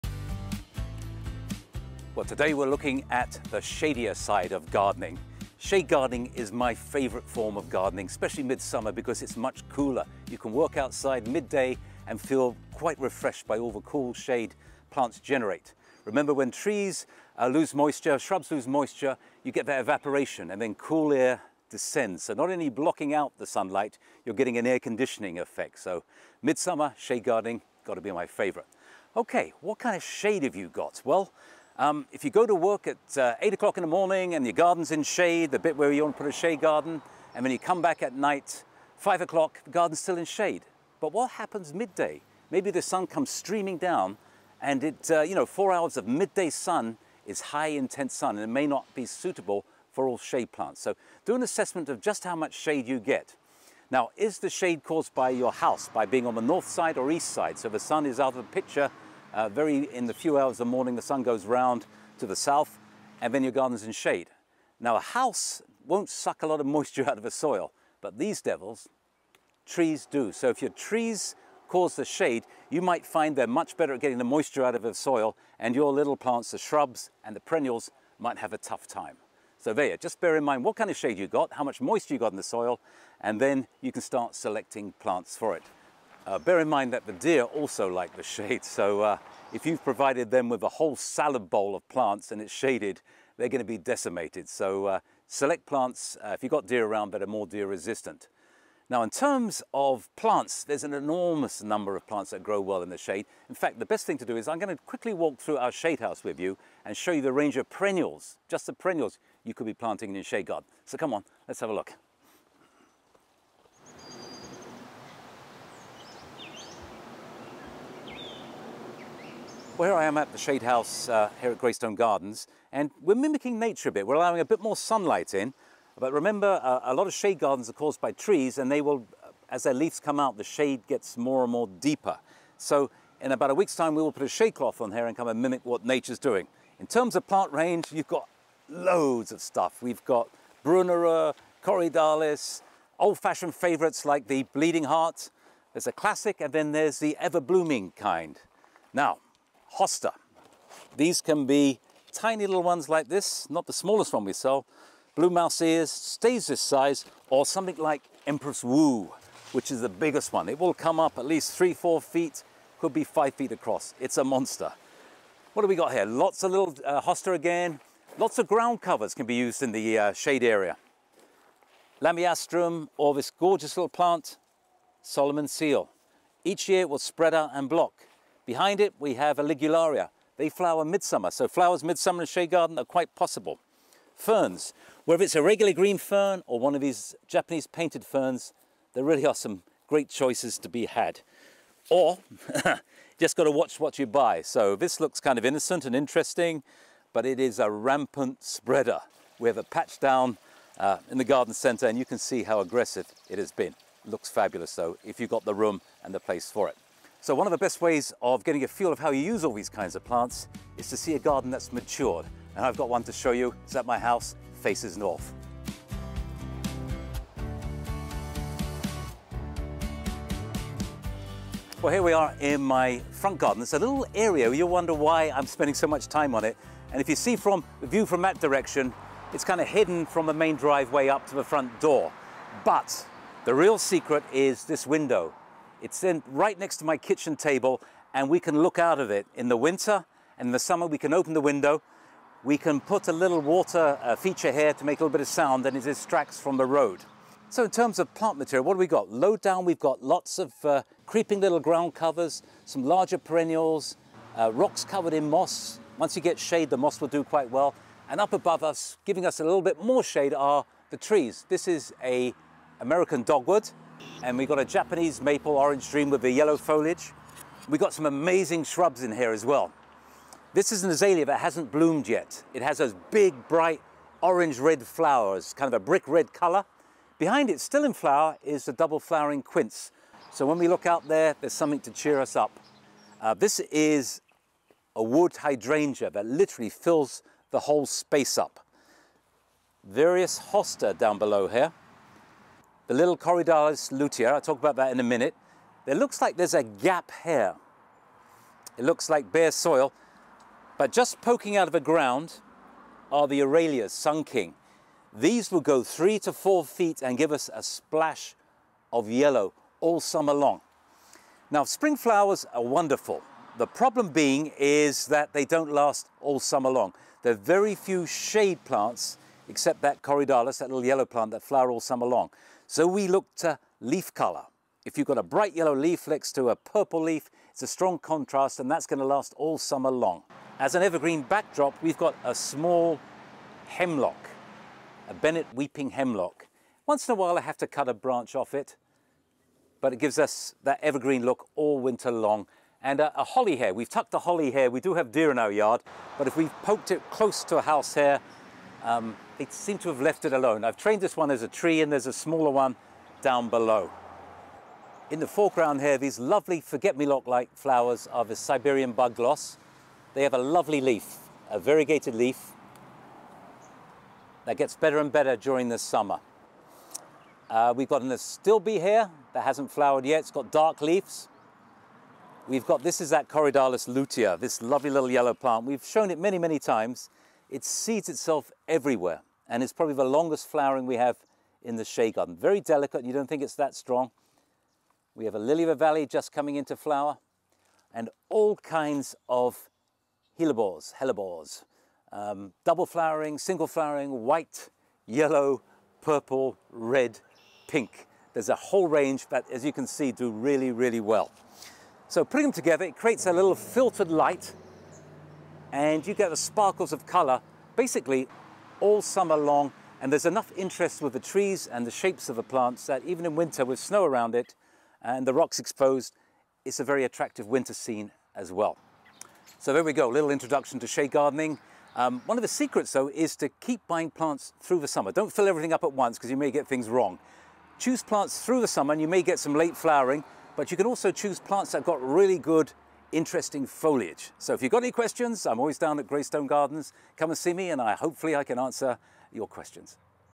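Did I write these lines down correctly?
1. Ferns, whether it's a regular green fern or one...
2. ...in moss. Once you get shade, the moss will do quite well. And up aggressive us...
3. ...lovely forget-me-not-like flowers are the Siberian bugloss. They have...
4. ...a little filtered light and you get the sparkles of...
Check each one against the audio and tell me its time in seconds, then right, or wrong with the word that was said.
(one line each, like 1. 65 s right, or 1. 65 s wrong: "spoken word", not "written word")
1. 184 s right
2. 255 s wrong: "above", not "aggressive"
3. 356 s right
4. 403 s right.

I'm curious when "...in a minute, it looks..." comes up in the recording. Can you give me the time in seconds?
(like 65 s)
294 s.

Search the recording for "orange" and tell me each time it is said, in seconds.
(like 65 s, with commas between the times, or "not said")
265 s, 274 s.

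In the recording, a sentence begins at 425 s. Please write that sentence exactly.
Don't fill everything up at once because you may get things wrong.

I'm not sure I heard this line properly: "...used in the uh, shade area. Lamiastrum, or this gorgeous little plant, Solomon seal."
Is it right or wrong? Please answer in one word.
right.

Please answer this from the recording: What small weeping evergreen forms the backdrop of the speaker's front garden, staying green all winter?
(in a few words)
Bennett weeping hemlock.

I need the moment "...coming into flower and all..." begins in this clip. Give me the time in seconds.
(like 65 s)
386 s.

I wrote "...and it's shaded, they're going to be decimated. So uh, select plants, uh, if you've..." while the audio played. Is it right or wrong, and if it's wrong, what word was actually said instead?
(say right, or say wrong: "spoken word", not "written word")
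right.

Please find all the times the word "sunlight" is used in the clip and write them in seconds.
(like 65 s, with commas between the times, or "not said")
23 s, 124 s.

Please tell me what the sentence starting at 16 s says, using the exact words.
Remember when trees uh, lose moisture, shrubs lose moisture, you get that evaporation and then cool air descends.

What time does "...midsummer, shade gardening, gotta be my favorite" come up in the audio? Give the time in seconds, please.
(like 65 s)
26 s.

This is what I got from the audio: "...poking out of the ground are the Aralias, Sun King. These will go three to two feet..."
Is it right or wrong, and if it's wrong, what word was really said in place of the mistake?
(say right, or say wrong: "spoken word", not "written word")
wrong: "four", not "two".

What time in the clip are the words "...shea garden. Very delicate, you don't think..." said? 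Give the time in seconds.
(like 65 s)
381 s.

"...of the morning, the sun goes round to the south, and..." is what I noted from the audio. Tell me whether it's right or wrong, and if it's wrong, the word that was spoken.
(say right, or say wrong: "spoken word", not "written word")
right.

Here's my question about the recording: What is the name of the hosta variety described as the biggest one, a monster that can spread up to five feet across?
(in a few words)
Empress Wu.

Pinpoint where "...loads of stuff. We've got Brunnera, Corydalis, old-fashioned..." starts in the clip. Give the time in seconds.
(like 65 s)
138 s.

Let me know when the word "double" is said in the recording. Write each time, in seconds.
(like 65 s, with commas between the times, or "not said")
278 s, 392 s.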